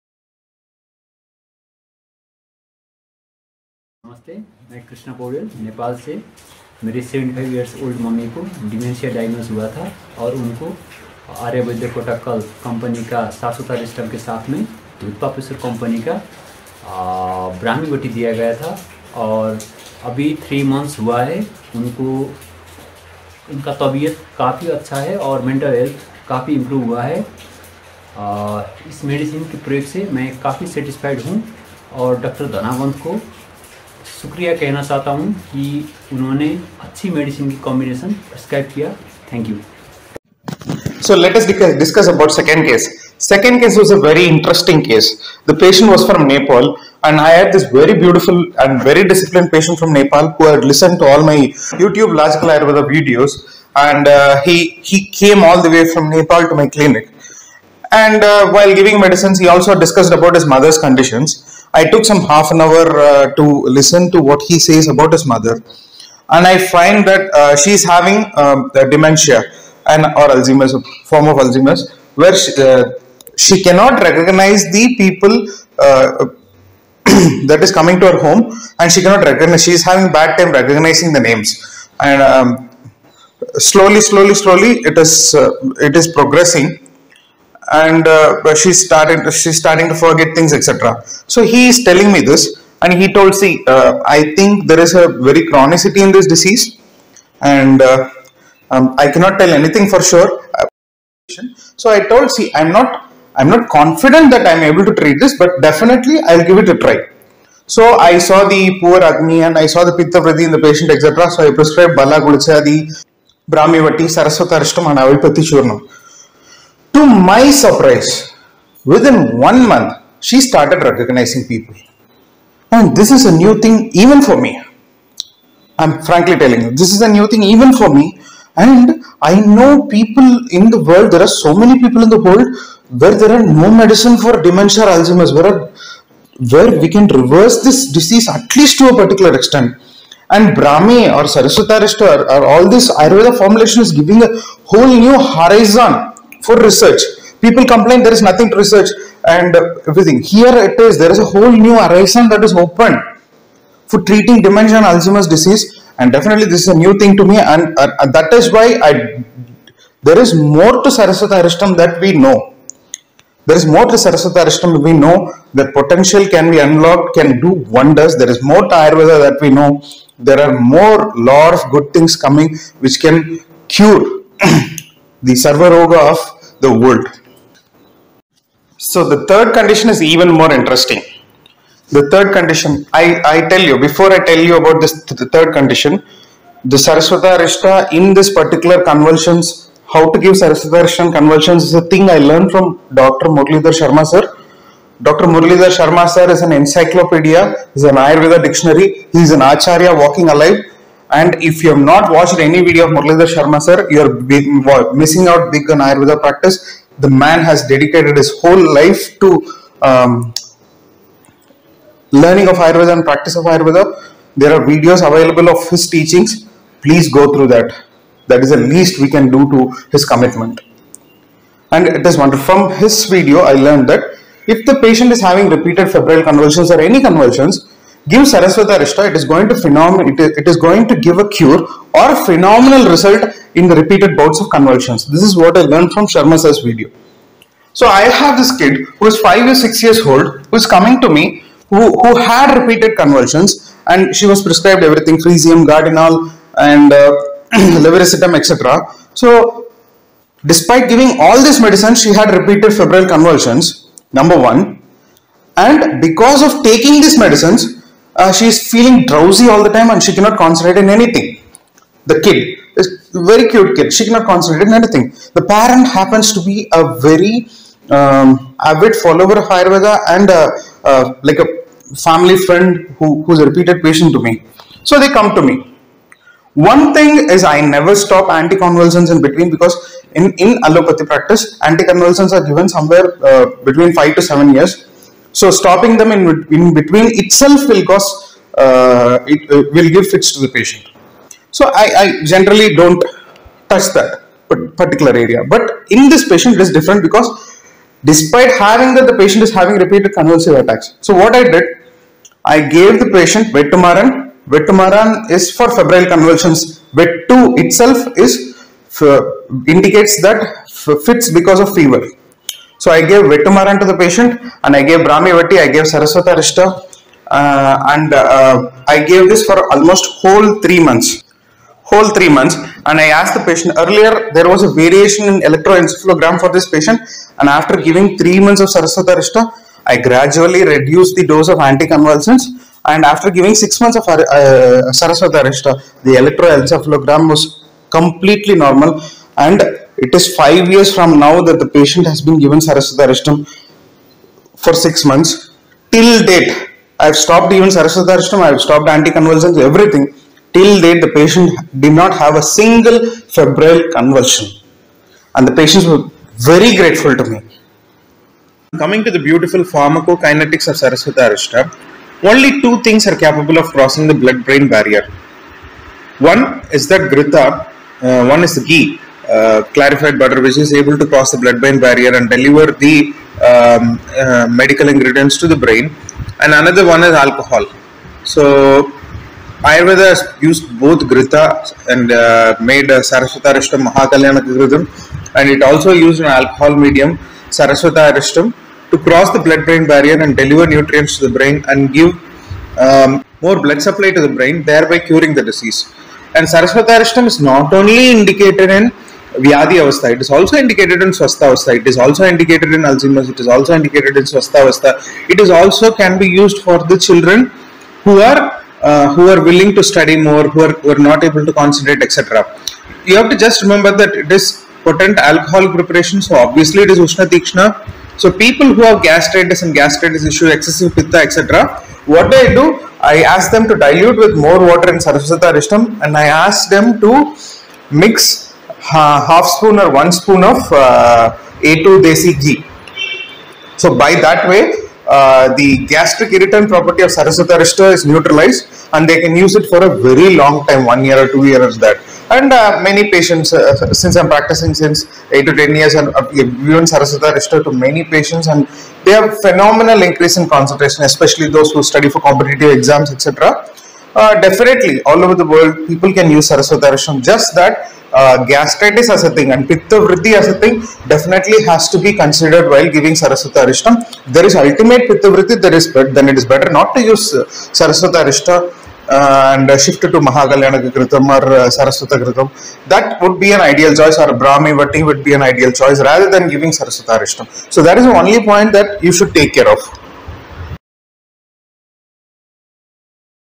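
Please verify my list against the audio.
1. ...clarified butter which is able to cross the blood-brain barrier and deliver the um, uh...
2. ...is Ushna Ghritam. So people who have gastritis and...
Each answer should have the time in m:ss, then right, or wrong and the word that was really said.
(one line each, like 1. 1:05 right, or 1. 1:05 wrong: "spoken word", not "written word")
1. 6:09 right
2. 6:56 wrong: "Tikshna", not "Ghritam".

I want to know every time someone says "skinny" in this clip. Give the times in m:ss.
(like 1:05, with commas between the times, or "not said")
not said.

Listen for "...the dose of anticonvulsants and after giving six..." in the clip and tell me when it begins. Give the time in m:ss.
5:31.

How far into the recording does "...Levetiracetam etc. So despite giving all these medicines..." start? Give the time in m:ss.
4:07.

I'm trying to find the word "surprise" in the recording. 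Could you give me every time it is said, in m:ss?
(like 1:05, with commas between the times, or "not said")
1:57.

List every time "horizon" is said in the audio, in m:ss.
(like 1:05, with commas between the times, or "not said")
2:25, 2:31.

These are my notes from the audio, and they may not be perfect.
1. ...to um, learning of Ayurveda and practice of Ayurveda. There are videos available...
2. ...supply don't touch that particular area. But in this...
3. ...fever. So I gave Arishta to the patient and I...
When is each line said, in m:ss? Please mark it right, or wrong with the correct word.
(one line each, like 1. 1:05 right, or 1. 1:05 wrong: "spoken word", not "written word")
1. 3:29 right
2. 4:52 wrong: "generally", not "supply"
3. 5:11 wrong: "Vetumaran", not "Arishta".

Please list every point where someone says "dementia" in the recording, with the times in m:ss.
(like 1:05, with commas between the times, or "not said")
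1:08, 2:14, 2:34.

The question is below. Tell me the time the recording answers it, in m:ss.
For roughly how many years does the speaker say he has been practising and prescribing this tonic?
7:25.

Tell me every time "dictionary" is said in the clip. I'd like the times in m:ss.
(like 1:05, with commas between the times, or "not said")
3:18.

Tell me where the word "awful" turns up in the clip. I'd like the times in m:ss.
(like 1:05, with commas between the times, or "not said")
not said.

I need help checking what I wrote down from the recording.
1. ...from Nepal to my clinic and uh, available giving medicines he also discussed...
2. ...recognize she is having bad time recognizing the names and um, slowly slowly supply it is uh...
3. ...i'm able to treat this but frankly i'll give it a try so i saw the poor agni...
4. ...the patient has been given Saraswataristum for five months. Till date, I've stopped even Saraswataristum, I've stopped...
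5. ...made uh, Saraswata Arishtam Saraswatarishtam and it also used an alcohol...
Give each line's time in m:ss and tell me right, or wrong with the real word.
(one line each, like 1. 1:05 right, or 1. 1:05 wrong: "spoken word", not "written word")
1. 0:55 wrong: "while", not "available"
2. 1:19 wrong: "slowly", not "supply"
3. 1:44 wrong: "definitely", not "frankly"
4. 5:41 wrong: "six", not "five"
5. 6:22 wrong: "Mahakalyana", not "Saraswatarishtam".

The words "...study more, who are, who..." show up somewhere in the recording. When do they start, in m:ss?
6:49.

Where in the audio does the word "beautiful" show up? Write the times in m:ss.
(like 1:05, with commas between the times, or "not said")
0:48, 5:59.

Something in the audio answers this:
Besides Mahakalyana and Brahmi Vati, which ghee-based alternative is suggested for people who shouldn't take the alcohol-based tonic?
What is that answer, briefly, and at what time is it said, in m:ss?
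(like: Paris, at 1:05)
Saraswata Ghritam, at 7:51.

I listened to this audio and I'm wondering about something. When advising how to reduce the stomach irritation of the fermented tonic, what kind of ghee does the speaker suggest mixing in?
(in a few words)
A2 desi ghee.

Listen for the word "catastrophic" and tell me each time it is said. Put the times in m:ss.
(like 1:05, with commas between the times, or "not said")
not said.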